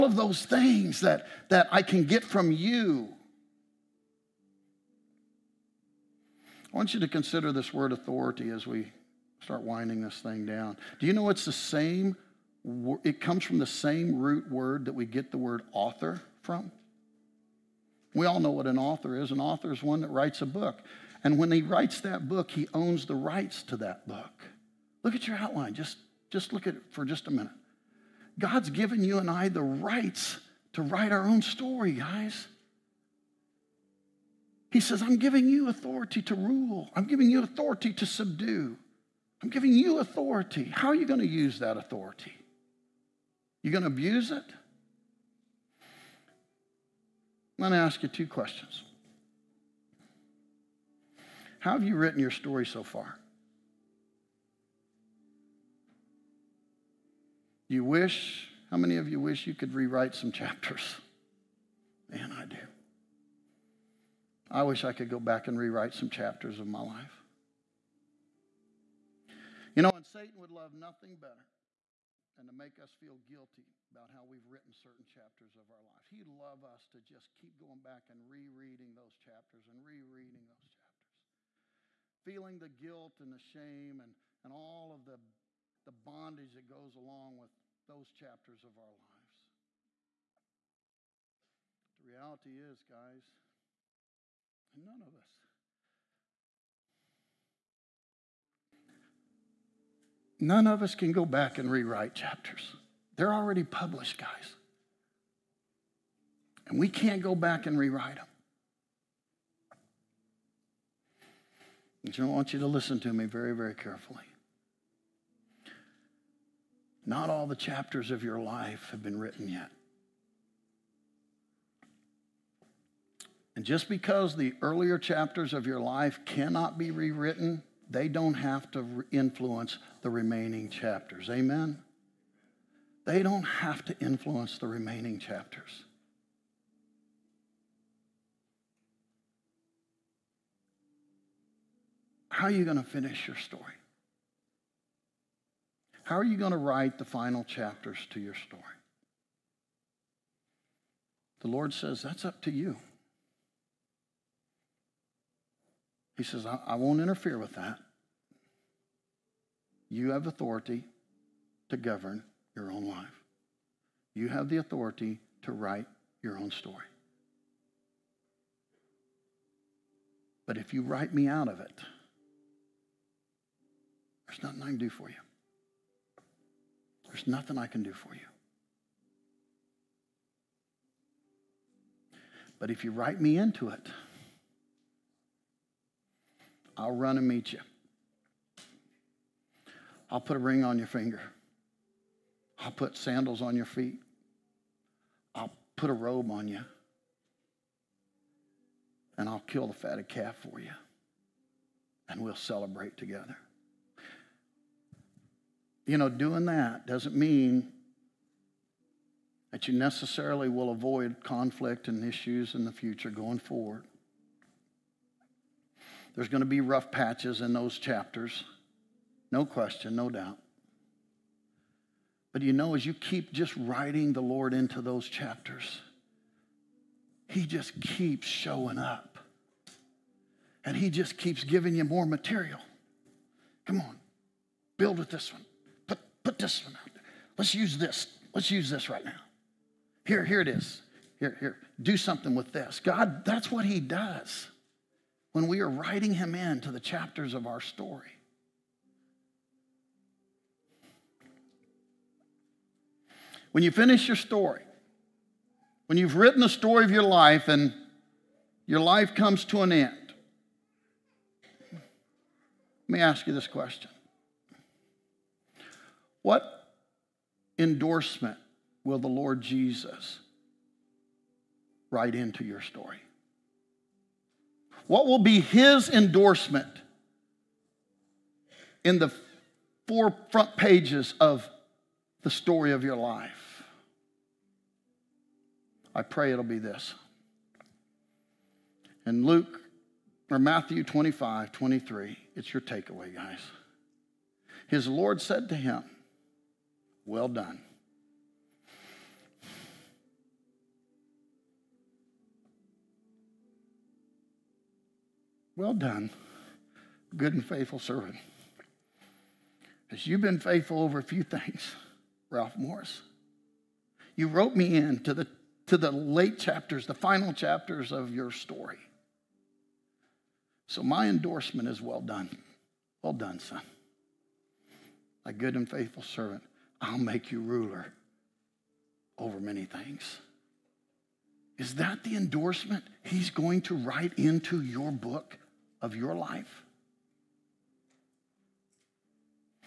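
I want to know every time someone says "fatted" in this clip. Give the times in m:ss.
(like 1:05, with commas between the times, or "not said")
3:19.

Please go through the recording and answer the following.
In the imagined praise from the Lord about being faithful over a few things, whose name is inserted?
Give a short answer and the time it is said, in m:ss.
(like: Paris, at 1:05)
Ralph Morris, at 5:12.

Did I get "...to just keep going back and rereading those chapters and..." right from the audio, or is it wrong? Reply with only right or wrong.
right.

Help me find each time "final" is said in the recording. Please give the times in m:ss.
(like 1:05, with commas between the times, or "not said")
2:27, 5:16.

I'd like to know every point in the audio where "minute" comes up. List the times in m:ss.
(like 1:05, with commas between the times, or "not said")
0:27.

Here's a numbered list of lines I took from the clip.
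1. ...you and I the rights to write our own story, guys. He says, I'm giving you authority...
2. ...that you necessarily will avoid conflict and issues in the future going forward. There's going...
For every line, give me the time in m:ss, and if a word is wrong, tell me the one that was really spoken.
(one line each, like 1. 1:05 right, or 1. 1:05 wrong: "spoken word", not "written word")
1. 0:29 right
2. 3:29 right.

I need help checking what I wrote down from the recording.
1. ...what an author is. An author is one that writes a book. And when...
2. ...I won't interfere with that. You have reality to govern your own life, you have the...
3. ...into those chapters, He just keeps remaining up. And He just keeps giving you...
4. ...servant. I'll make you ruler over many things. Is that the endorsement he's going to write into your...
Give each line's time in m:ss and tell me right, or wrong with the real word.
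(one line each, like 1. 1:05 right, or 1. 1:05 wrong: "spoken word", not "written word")
1. 0:18 right
2. 2:36 wrong: "authority", not "reality"
3. 3:44 wrong: "showing", not "remaining"
4. 5:26 right.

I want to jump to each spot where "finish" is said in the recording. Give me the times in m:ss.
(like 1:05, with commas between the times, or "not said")
2:22, 4:13.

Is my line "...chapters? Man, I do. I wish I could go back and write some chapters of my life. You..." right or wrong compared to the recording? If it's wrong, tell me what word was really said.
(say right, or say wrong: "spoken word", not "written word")
wrong: "rewrite", not "write".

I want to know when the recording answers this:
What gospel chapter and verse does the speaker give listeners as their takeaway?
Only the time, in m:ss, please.
4:50.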